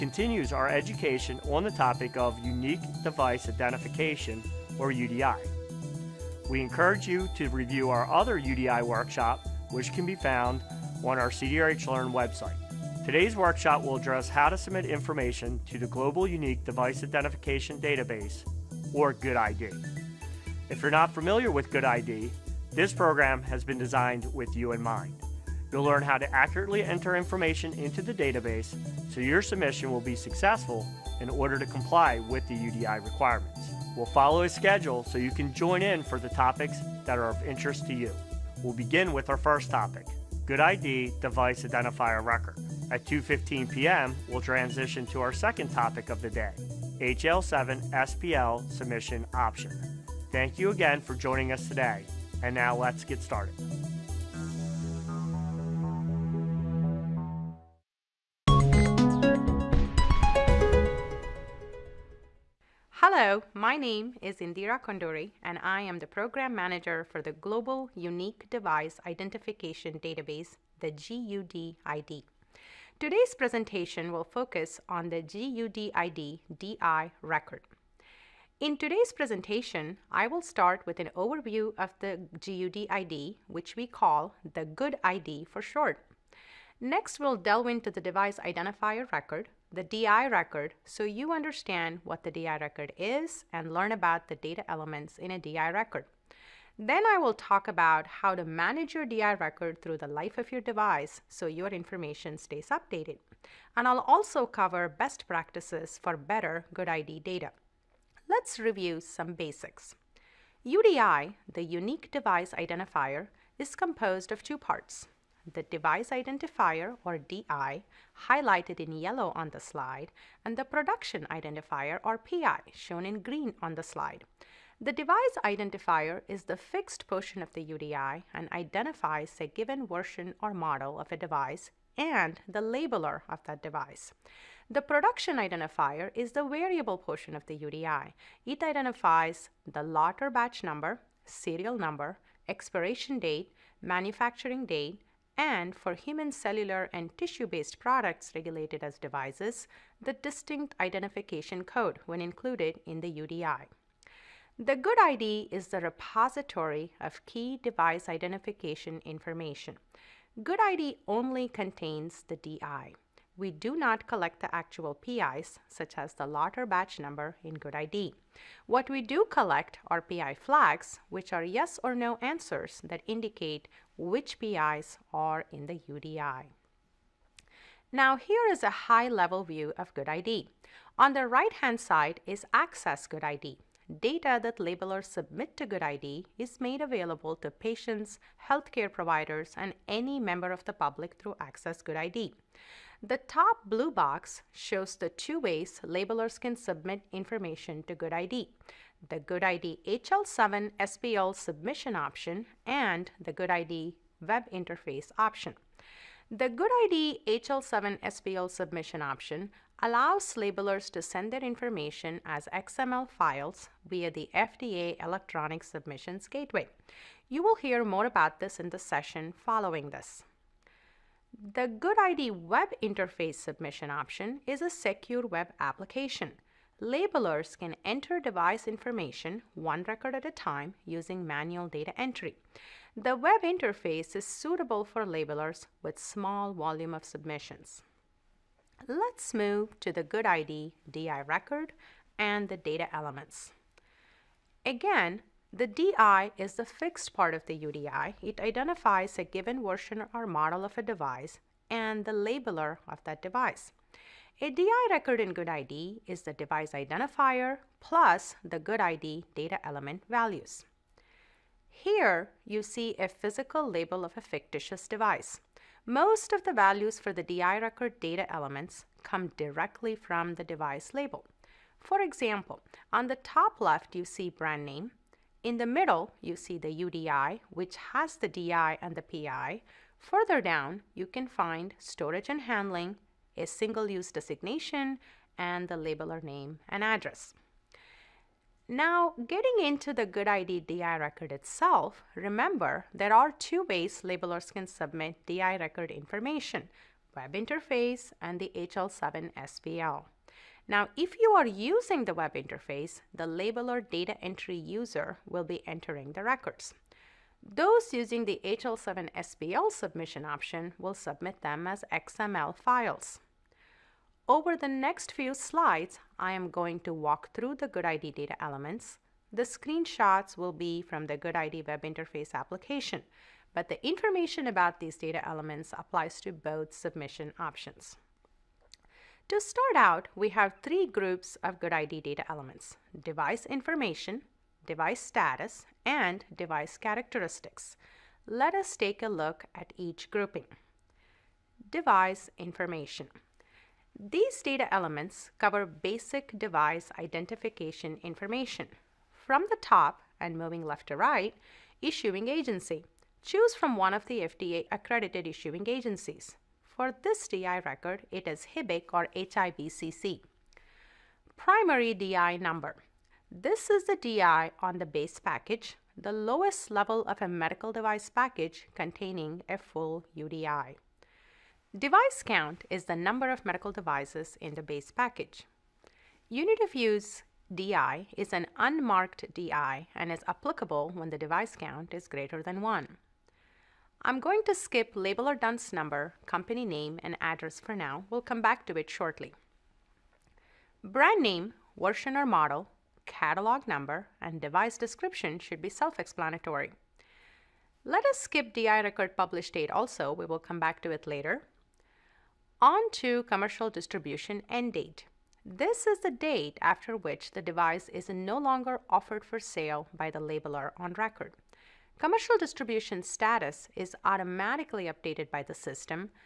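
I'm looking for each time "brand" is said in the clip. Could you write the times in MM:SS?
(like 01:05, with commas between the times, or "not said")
04:34, 06:30.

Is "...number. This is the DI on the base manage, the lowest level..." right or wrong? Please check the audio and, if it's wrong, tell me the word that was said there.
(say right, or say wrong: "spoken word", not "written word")
wrong: "package", not "manage".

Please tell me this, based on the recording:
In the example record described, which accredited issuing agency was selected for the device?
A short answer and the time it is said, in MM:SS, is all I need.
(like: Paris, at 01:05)
HIBCC, at 05:59.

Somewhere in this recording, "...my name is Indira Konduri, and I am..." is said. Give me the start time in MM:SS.
01:03.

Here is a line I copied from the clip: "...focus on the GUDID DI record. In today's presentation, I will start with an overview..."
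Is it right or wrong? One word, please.
right.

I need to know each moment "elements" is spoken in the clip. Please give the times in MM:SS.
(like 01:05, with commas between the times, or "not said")
01:34, 04:02, 04:19, 04:28, 05:18, 05:25, 05:32, 05:44.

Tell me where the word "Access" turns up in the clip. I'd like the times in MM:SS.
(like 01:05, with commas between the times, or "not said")
03:02, 03:11.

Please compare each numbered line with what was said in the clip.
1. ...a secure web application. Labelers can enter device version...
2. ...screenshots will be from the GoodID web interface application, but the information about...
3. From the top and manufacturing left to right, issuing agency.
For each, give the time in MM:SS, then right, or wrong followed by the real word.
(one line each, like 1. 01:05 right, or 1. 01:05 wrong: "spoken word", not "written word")
1. 03:44 wrong: "information", not "version"
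2. 05:19 right
3. 05:49 wrong: "moving", not "manufacturing".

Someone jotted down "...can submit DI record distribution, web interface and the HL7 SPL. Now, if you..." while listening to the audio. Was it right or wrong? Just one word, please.
wrong.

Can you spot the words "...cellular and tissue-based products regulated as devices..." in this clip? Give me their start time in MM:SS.
02:26.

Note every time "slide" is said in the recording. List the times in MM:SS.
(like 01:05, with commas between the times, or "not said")
01:59, 02:03, 05:15.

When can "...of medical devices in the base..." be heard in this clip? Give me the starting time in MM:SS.
06:13.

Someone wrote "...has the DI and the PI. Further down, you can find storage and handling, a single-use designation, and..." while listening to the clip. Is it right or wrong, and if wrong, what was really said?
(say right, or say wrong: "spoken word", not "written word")
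right.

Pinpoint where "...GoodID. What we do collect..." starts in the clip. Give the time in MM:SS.
02:47.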